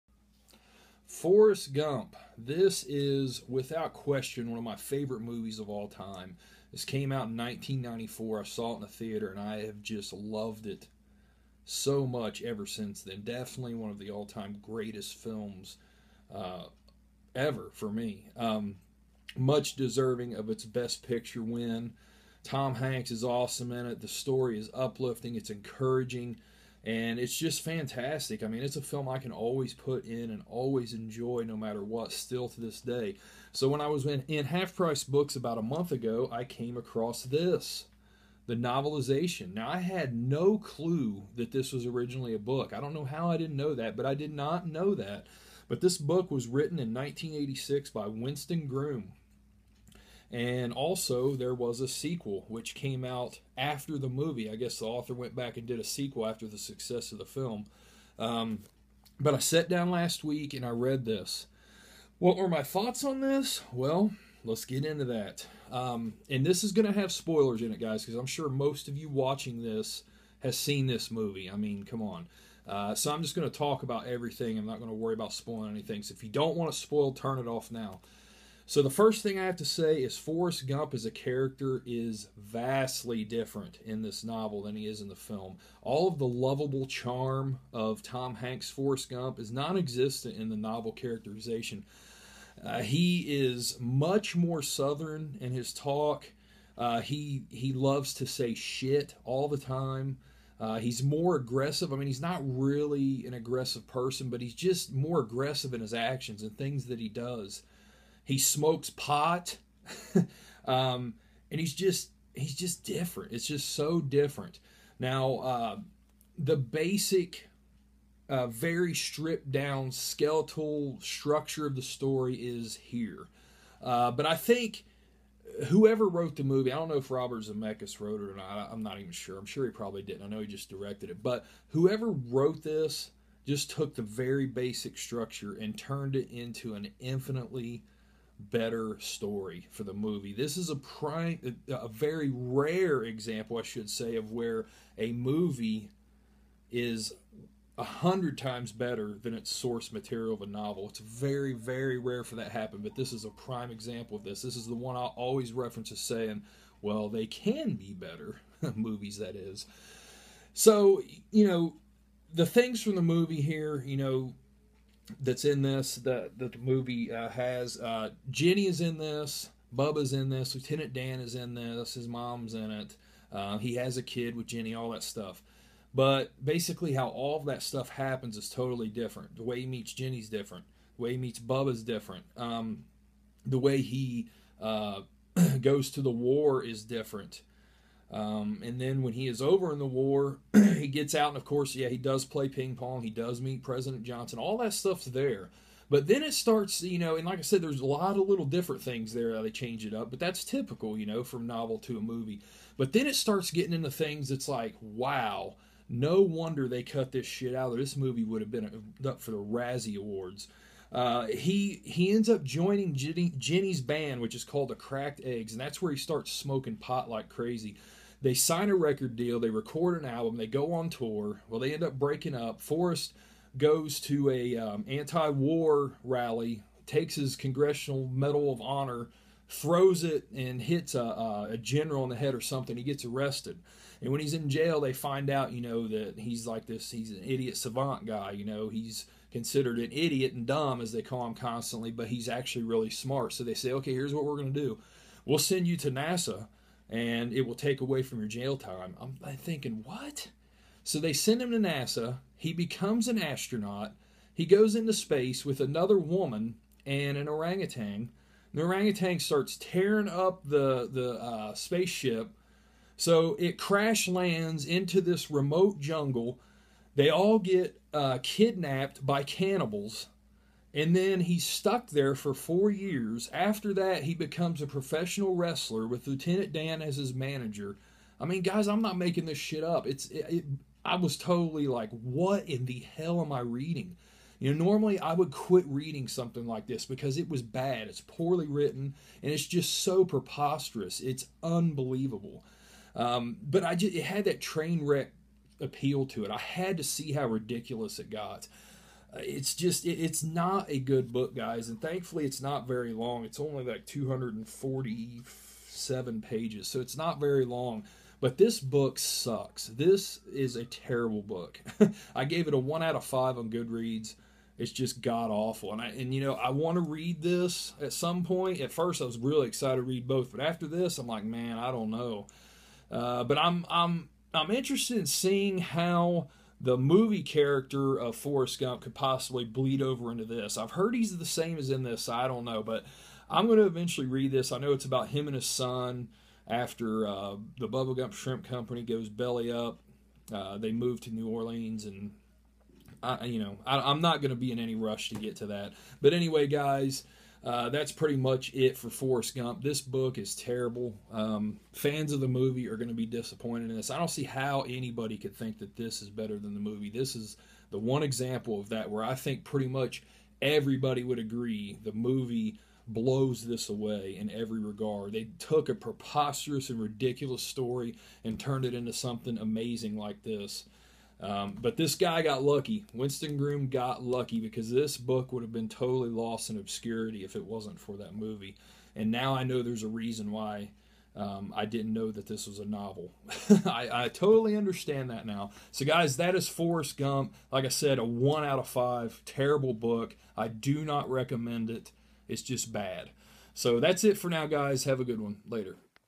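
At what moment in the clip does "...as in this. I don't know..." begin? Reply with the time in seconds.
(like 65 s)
331 s.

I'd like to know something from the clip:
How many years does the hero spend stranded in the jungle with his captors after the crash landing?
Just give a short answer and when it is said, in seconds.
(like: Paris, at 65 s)
4, at 272 s.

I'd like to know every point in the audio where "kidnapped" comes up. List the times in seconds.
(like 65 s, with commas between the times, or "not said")
268 s.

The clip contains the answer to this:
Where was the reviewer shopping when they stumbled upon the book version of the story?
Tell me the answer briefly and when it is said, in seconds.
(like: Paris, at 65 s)
Half Price Books, at 34 s.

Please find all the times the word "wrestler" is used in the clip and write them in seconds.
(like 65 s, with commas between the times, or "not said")
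275 s.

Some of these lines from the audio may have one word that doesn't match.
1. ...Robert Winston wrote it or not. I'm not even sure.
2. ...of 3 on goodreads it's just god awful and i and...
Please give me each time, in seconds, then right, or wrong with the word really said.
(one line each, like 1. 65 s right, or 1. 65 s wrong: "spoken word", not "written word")
1. 127 s wrong: "Zemeckis", not "Winston"
2. 312 s wrong: "5", not "3".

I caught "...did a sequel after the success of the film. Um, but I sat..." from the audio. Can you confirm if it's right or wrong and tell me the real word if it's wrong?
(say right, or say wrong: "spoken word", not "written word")
right.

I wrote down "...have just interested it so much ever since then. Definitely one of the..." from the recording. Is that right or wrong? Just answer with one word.
wrong.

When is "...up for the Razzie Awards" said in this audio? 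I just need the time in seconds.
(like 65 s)
209 s.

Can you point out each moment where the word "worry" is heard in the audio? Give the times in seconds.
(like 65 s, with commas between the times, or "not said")
74 s.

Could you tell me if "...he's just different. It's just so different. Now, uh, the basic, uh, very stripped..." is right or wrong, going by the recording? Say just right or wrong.
right.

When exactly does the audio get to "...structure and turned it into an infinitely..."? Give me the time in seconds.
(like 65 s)
134 s.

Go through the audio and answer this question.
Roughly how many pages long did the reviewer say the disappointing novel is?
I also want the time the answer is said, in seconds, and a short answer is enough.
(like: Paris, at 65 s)
247, at 303 s.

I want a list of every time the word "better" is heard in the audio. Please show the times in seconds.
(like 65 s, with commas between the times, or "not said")
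138 s, 148 s, 157 s, 356 s.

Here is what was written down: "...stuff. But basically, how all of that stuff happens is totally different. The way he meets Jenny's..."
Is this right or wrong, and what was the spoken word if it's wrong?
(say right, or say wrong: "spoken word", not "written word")
right.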